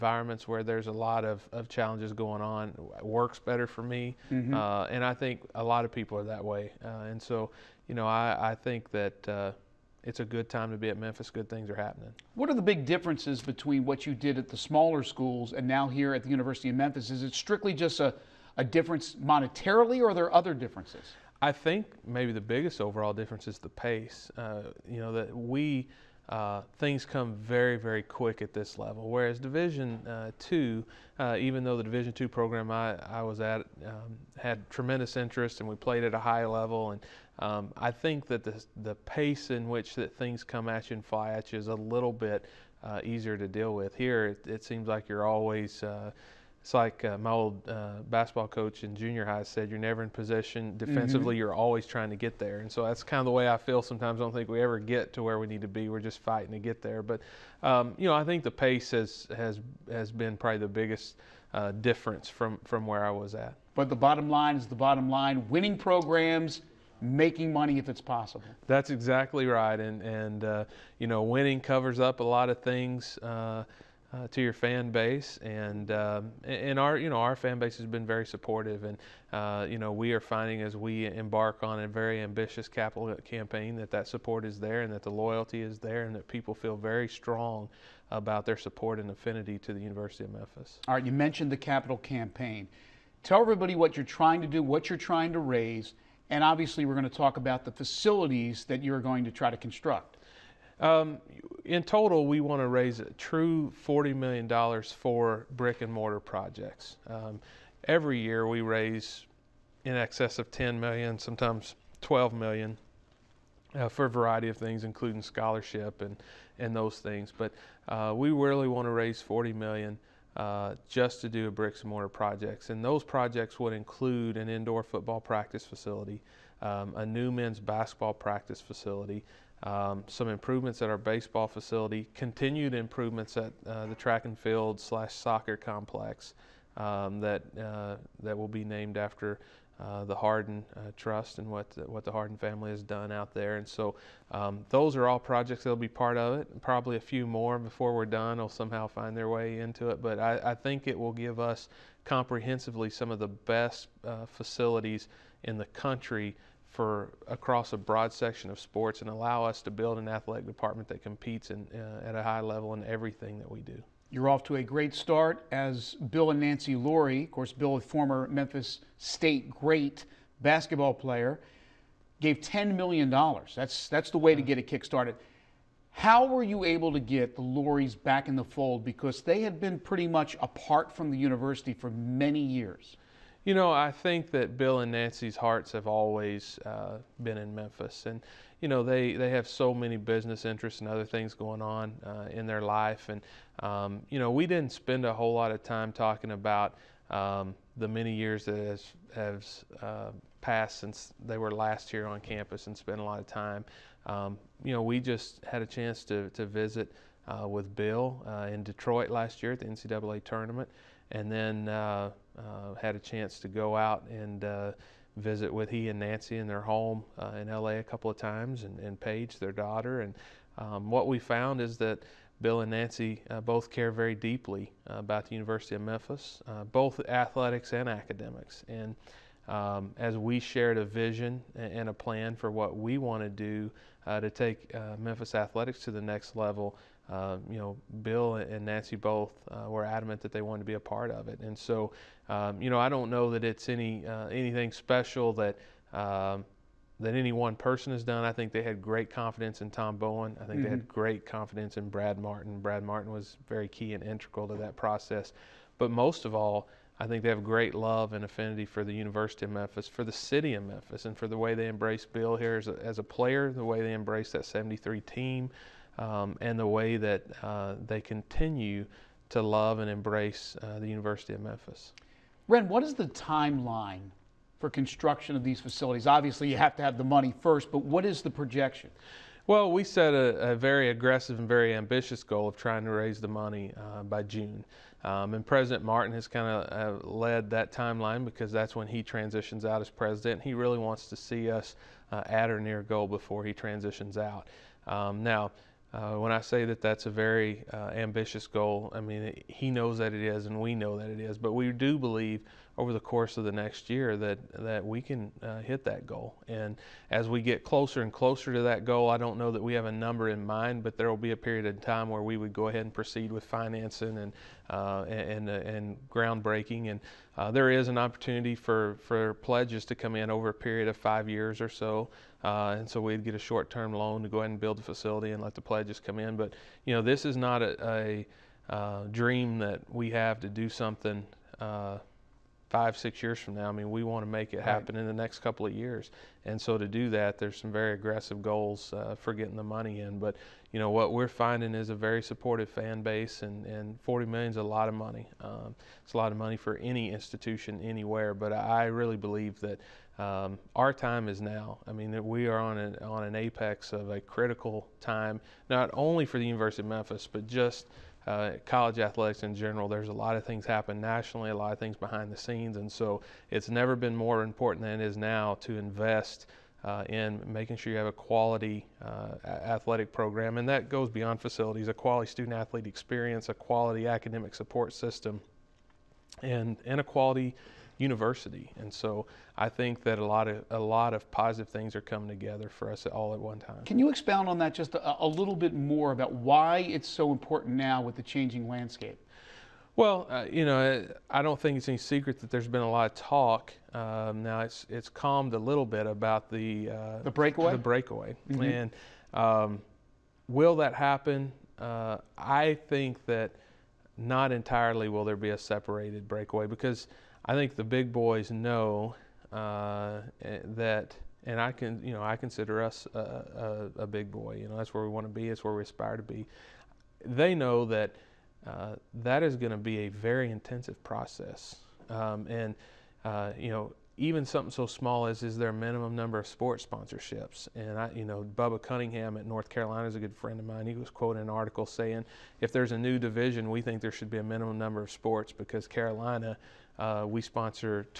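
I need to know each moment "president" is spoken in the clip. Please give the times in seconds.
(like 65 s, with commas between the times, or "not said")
285 s, 289 s.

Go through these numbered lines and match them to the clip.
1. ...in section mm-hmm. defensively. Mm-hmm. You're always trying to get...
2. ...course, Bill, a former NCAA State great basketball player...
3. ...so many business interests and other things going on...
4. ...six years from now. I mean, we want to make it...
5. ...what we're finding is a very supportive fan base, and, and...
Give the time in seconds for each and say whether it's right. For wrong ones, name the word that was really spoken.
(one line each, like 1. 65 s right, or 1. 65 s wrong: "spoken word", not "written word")
1. 50 s wrong: "possession", not "section"
2. 167 s wrong: "Memphis", not "NCAA"
3. 189 s right
4. 332 s right
5. 340 s right.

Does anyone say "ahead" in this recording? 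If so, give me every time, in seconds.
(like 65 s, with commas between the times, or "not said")
312 s, 324 s.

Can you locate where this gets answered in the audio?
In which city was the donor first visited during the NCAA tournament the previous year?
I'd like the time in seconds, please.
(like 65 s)
208 s.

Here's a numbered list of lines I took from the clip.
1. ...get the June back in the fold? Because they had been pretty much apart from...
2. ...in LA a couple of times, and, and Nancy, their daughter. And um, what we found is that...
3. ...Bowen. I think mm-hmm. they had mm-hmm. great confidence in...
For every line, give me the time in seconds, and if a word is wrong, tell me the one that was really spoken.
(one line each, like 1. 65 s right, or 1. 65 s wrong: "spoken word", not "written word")
1. 176 s wrong: "Lauries", not "June"
2. 217 s wrong: "Paige", not "Nancy"
3. 249 s right.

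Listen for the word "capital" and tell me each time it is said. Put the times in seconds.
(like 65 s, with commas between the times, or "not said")
82 s, 91 s.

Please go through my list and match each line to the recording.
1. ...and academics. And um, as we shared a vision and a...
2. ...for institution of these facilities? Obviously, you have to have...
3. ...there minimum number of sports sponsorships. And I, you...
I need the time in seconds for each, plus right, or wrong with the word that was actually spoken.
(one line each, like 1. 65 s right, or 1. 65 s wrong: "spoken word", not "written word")
1. 227 s right
2. 274 s wrong: "construction", not "institution"
3. 425 s right.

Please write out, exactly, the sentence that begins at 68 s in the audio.
That's exactly right, and and uh, you know, winning covers up a lot of things.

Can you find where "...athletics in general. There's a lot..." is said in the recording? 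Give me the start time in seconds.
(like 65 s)
358 s.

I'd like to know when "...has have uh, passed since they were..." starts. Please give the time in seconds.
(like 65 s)
198 s.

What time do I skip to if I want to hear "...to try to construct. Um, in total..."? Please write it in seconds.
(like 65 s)
99 s.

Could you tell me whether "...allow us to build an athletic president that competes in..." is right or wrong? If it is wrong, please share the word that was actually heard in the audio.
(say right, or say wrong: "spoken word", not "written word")
wrong: "department", not "president".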